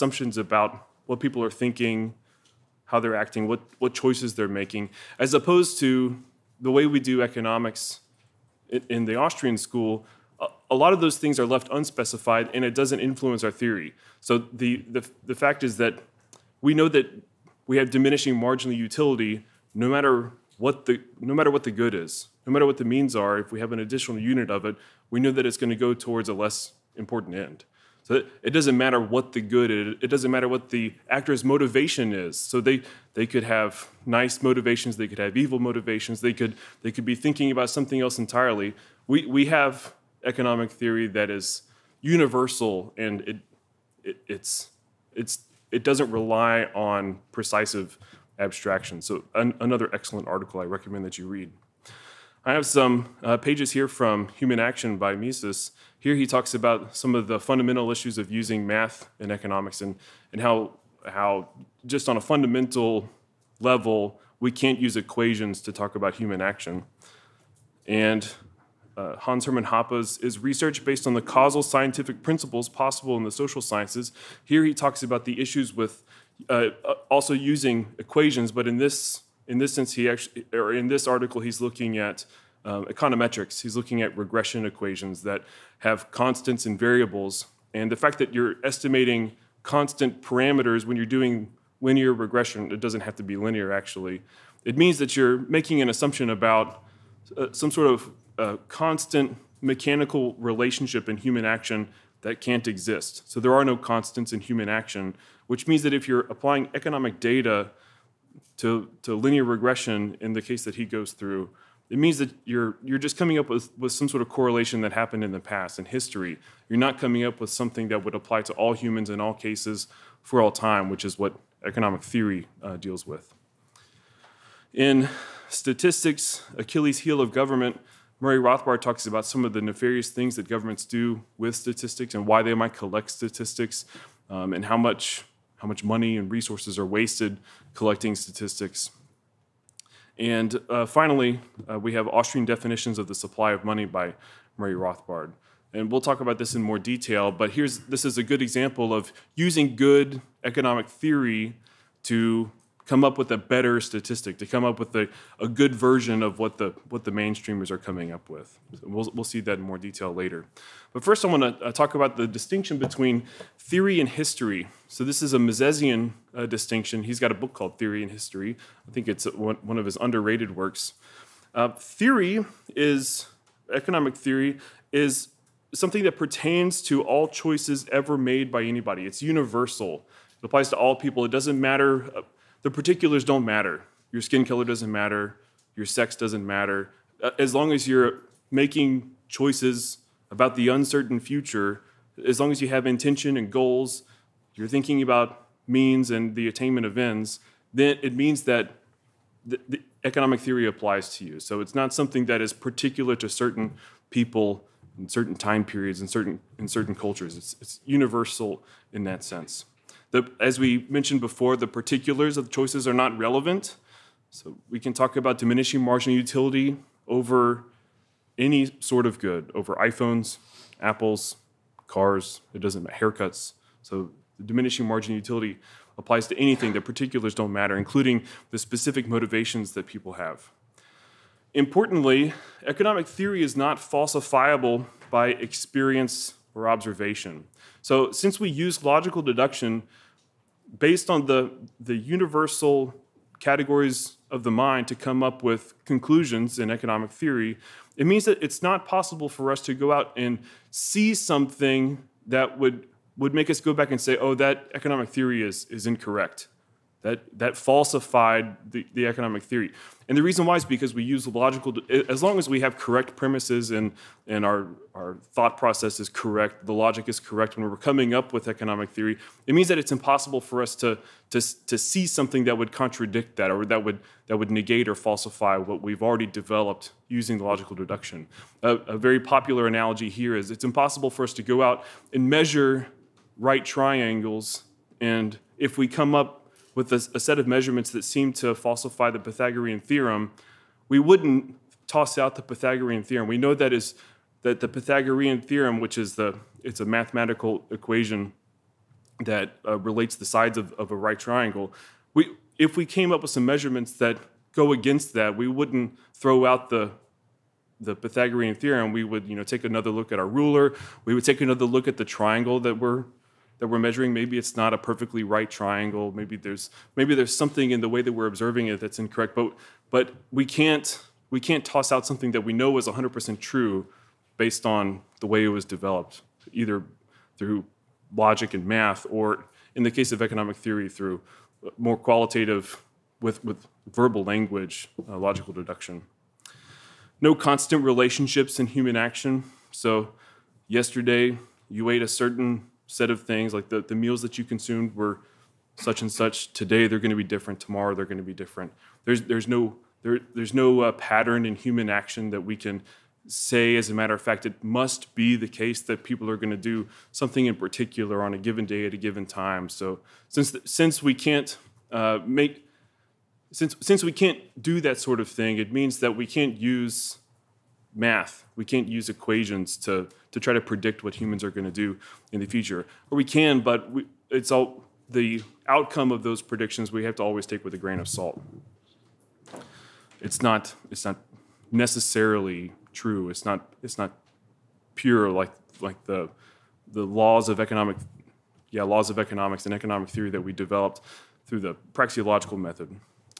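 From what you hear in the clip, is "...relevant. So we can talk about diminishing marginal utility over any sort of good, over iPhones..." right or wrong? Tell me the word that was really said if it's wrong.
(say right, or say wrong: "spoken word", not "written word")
right.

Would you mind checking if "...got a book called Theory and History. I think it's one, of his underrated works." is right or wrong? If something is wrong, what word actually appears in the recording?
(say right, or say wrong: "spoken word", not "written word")
right.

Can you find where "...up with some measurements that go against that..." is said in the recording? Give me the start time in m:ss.
5:03.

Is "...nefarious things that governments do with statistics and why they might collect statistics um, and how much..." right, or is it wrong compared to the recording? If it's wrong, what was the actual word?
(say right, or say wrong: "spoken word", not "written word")
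right.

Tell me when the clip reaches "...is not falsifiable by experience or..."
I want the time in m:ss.
3:53.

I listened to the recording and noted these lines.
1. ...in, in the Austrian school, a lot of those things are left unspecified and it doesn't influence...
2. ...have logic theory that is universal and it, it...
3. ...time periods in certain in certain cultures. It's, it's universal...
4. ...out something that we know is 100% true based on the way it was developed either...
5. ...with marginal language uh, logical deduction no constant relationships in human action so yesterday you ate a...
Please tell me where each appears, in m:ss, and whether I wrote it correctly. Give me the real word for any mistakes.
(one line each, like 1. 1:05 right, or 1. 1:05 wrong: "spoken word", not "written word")
1. 0:08 right
2. 0:39 wrong: "economic", not "logic"
3. 3:25 right
4. 5:21 right
5. 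5:33 wrong: "verbal", not "marginal".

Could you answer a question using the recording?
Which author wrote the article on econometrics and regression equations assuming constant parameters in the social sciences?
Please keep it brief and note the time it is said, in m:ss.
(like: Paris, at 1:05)
Hans Hermann Hoppe, at 1:09.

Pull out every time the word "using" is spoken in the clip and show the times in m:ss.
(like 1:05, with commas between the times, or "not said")
0:58, 1:17, 2:29, 4:37.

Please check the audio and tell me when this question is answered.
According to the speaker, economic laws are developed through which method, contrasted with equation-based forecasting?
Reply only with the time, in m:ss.
6:31.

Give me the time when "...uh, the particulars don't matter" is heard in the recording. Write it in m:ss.
3:02.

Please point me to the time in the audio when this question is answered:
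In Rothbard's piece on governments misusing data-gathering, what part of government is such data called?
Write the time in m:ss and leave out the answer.
2:06.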